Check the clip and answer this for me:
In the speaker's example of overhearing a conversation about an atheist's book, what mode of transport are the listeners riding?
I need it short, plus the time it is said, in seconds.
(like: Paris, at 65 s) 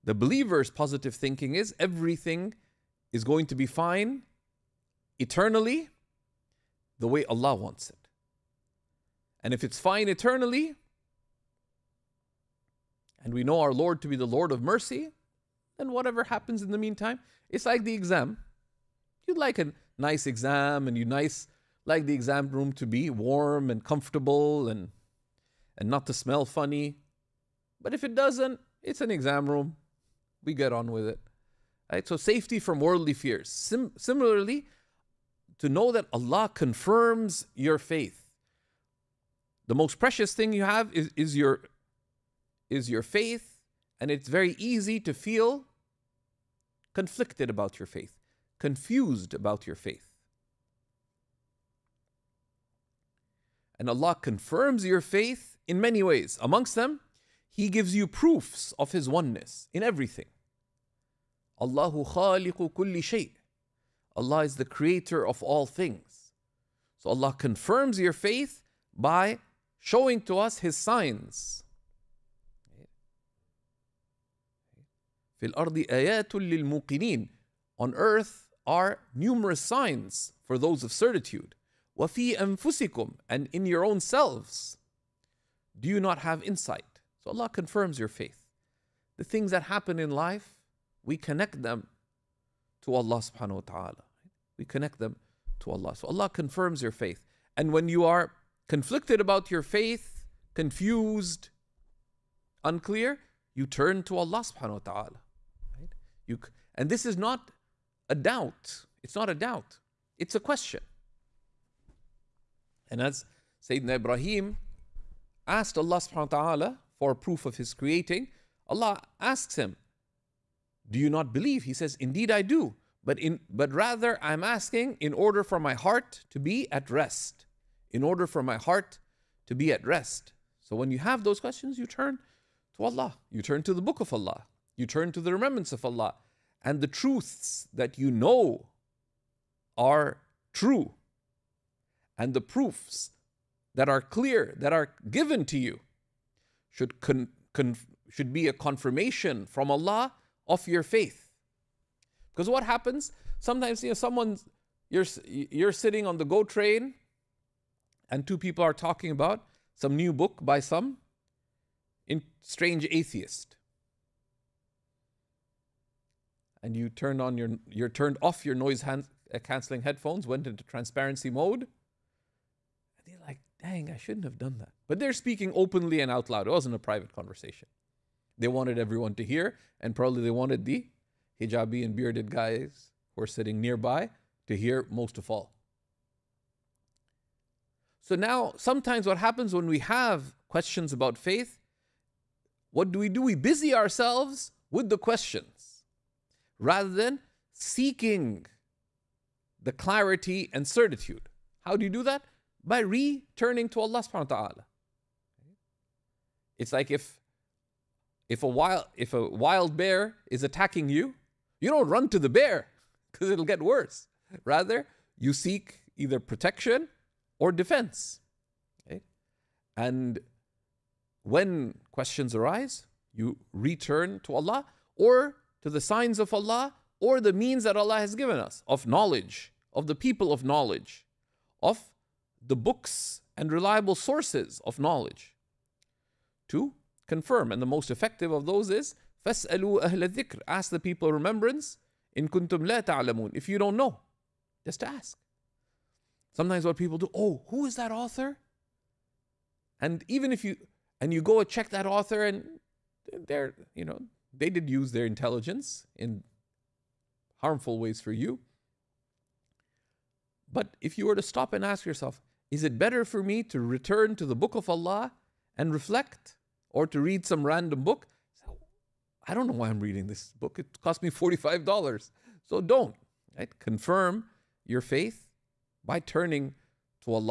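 GO train, at 156 s.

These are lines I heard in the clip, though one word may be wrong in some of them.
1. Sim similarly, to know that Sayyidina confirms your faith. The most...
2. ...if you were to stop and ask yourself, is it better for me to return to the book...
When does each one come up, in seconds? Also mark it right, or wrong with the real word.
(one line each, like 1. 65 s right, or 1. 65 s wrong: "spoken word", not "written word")
1. 33 s wrong: "Allah", not "Sayyidina"
2. 260 s right.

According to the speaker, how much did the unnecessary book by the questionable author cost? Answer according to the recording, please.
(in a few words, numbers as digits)
$45.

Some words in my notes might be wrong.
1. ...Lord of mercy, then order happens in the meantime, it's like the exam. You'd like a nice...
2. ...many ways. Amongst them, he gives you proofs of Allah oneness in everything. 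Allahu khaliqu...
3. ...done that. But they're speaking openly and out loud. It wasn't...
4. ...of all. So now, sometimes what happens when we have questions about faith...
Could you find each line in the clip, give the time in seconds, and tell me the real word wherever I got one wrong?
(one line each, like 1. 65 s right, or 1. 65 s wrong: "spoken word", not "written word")
1. 14 s wrong: "whatever", not "order"
2. 55 s wrong: "His", not "Allah"
3. 174 s right
4. 185 s right.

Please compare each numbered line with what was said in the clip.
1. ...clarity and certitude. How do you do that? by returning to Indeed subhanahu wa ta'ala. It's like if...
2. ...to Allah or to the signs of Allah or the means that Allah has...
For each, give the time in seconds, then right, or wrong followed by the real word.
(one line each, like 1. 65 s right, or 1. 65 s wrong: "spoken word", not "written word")
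1. 199 s wrong: "Allah", not "Indeed"
2. 224 s right.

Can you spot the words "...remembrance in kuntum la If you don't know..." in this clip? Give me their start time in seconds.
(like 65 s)
241 s.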